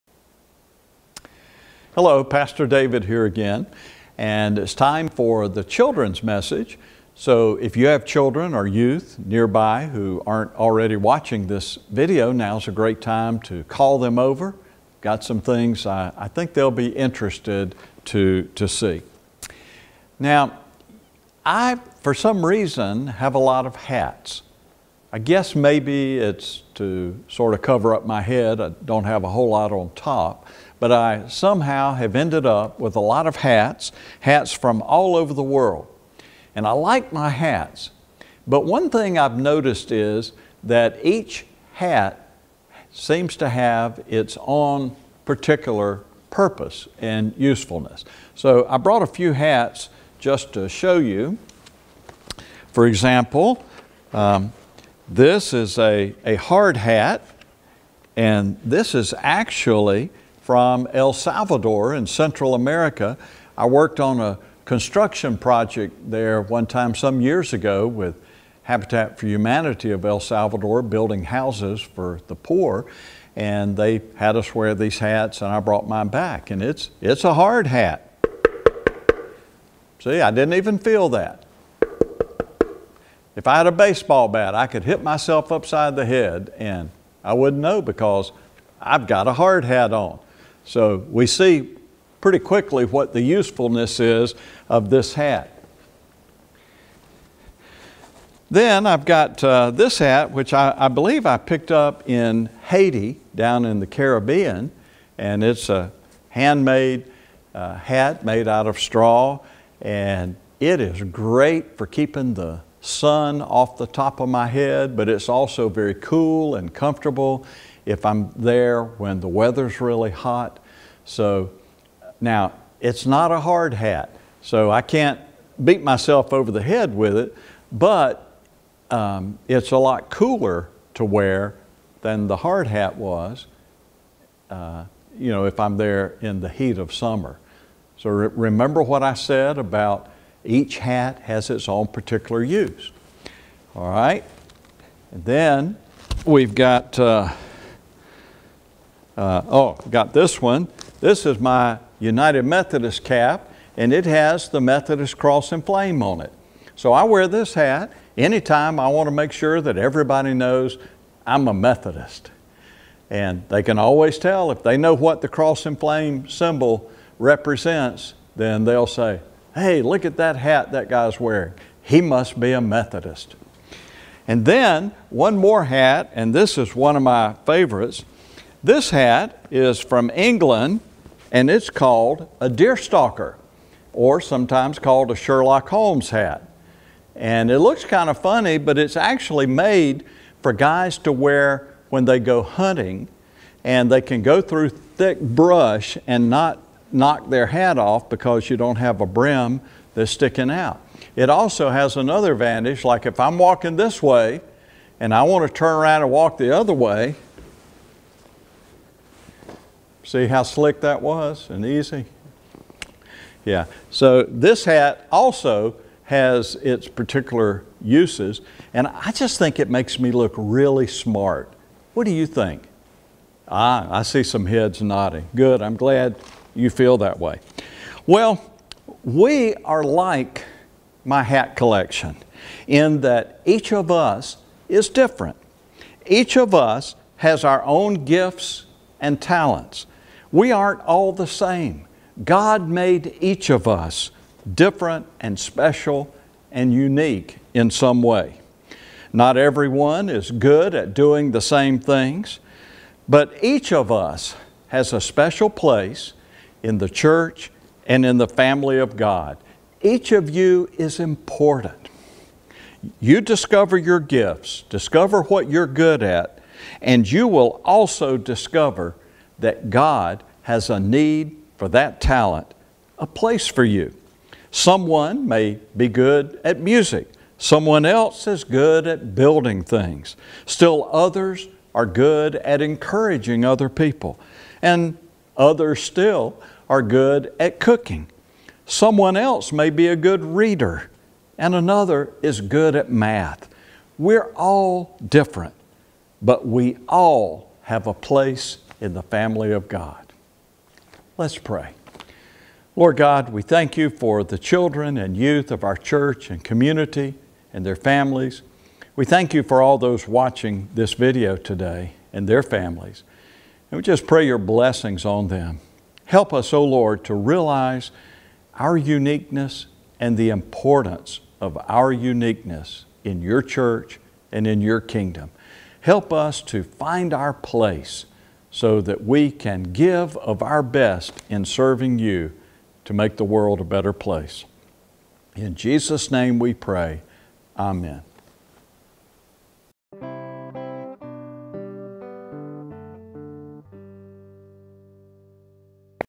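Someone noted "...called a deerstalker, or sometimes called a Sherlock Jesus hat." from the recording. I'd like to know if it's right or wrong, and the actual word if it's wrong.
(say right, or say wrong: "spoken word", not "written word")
wrong: "Holmes", not "Jesus".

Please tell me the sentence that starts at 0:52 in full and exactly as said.
For example, um, this is a, a hard hat, and this is actually from El Salvador in Central America.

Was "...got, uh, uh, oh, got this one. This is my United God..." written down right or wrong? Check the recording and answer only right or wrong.
wrong.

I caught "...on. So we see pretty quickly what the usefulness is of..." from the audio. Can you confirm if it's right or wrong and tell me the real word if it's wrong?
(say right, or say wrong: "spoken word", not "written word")
right.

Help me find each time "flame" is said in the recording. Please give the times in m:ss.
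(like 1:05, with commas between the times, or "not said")
2:35, 2:45.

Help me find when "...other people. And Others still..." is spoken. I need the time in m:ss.
4:43.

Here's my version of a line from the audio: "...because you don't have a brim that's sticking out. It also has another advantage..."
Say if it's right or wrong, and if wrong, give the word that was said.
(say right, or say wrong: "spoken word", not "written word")
right.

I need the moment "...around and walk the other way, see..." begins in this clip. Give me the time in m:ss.
3:25.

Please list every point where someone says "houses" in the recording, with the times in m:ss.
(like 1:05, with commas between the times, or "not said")
1:11.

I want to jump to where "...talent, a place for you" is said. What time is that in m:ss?
4:32.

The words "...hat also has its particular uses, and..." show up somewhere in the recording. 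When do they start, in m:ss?
3:34.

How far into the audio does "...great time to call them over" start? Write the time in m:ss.
0:12.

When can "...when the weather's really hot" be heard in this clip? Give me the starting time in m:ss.
1:58.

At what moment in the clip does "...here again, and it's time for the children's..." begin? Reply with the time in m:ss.
0:03.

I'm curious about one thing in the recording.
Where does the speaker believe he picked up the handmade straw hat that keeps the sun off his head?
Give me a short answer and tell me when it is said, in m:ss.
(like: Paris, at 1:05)
Haiti, at 1:42.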